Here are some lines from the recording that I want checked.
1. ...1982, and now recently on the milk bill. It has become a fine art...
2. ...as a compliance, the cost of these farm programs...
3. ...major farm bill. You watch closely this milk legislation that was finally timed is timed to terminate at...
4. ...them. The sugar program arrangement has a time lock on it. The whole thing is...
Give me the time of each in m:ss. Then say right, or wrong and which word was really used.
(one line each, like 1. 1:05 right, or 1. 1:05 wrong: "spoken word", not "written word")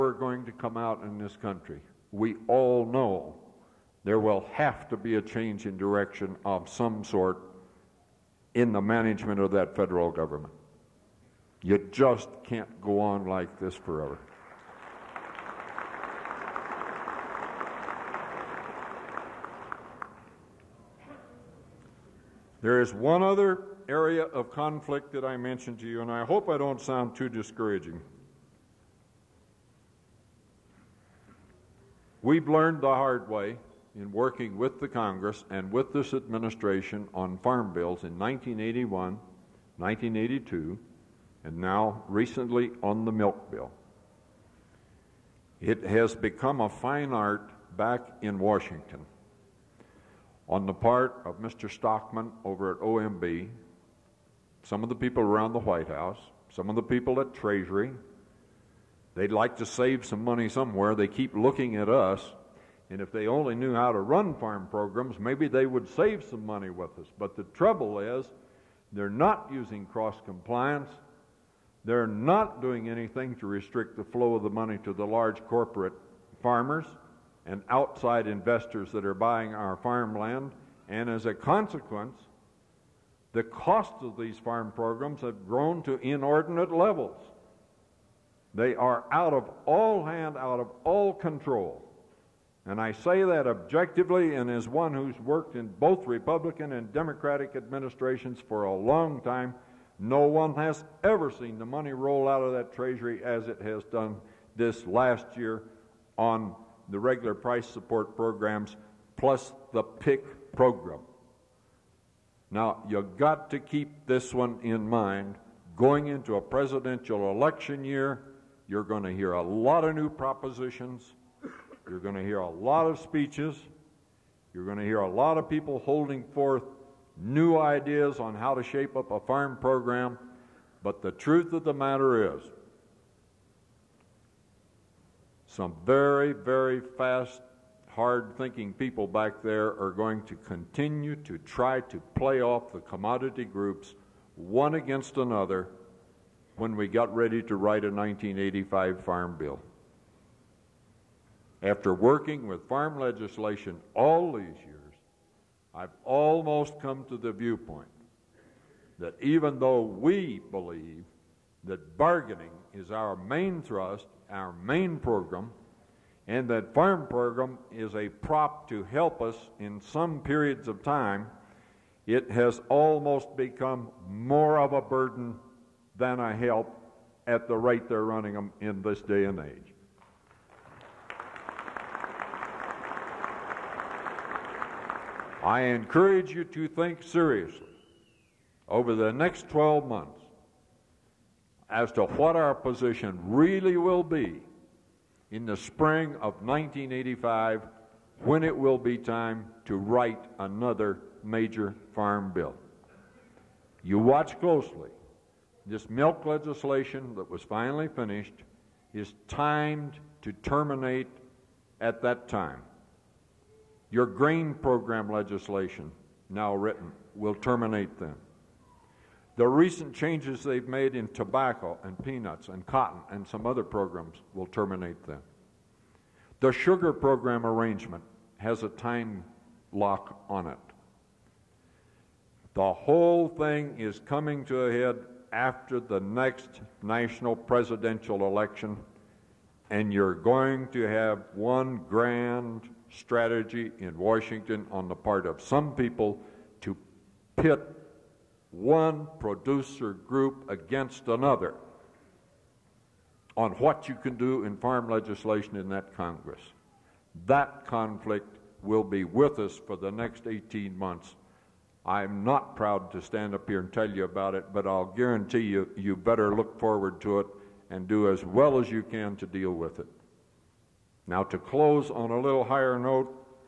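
1. 0:39 right
2. 1:21 wrong: "consequence", not "compliance"
3. 3:21 wrong: "finished", not "timed"
4. 3:45 right.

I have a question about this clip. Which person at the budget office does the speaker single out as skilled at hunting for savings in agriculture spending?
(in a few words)
Mr. Stockman.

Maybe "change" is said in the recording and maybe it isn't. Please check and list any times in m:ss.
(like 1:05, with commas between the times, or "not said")
0:05, 3:39.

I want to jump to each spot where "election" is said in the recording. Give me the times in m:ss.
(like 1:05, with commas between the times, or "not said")
1:57, 3:58.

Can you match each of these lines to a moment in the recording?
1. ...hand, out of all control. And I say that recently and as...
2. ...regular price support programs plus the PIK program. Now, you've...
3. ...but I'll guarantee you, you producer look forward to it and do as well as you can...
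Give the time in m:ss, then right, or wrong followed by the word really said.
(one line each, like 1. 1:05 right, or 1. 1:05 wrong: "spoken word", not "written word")
1. 1:30 wrong: "objectively", not "recently"
2. 1:46 right
3. 4:24 wrong: "better", not "producer".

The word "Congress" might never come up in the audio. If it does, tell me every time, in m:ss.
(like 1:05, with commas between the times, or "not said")
0:34, 4:15.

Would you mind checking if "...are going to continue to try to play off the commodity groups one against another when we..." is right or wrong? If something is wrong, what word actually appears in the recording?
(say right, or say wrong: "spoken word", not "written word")
right.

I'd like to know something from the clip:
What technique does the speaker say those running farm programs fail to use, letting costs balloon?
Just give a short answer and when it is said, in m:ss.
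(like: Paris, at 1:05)
cross compliance, at 1:09.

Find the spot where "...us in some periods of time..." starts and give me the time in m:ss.
2:49.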